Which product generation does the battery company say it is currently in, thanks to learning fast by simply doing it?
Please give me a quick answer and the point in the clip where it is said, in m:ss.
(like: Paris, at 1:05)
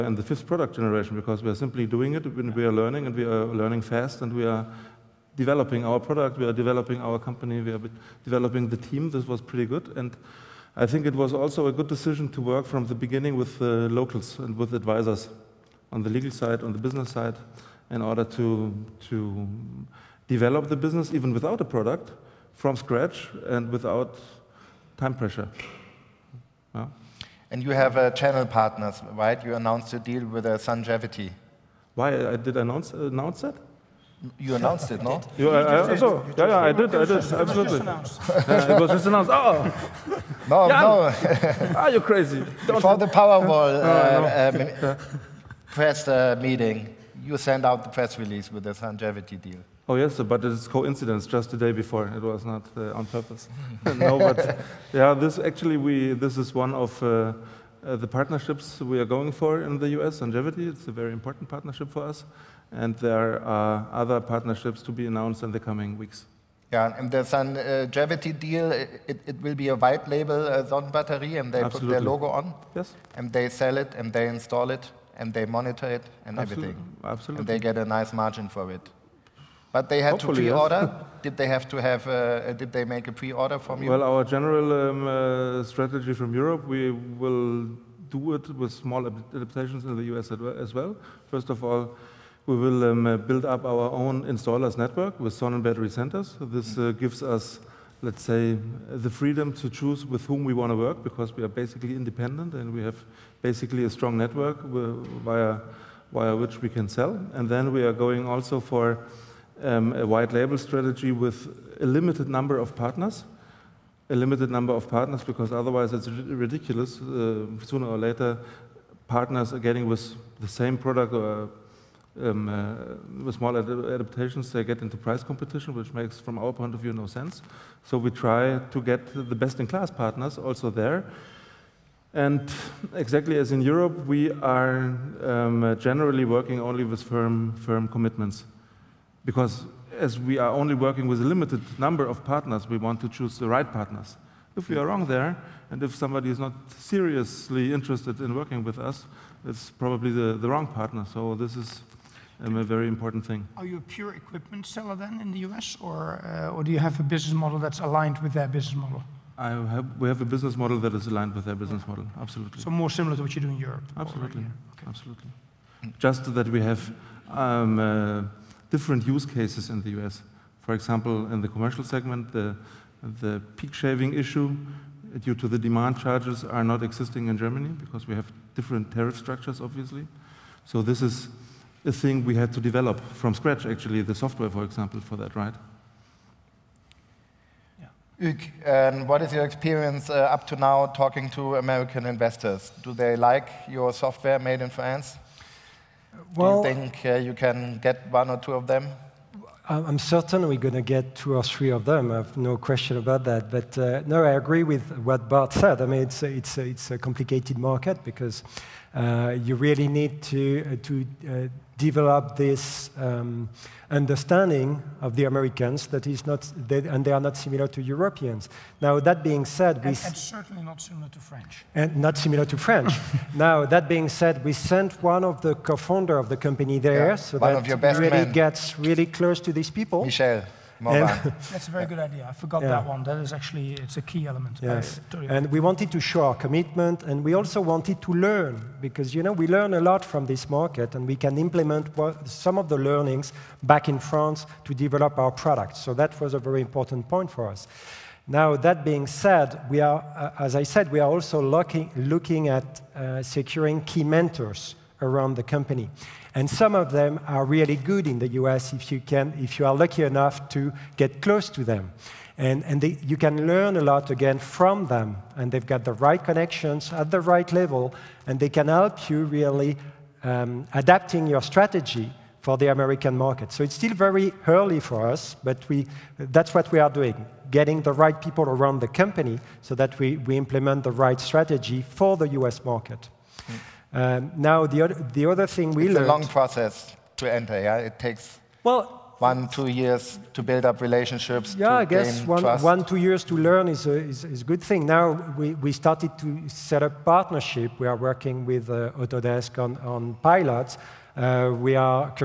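fifth, at 0:00.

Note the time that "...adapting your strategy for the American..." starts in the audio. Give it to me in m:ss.
4:30.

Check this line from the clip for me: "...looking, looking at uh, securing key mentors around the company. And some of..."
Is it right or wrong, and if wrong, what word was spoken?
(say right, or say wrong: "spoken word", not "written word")
right.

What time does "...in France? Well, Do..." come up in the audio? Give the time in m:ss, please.
3:14.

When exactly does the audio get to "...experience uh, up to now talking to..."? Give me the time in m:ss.
3:09.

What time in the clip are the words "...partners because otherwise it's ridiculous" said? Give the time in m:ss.
1:54.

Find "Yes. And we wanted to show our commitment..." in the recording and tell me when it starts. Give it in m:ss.
3:54.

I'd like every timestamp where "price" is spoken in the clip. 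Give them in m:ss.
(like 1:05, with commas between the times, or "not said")
2:04.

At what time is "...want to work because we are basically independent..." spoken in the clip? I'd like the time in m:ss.
1:40.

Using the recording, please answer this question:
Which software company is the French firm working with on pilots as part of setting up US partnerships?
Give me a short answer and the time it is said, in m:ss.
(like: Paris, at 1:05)
Autodesk, at 4:58.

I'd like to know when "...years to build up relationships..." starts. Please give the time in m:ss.
4:49.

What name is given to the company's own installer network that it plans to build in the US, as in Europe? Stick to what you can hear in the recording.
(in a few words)
Sonnen battery centers.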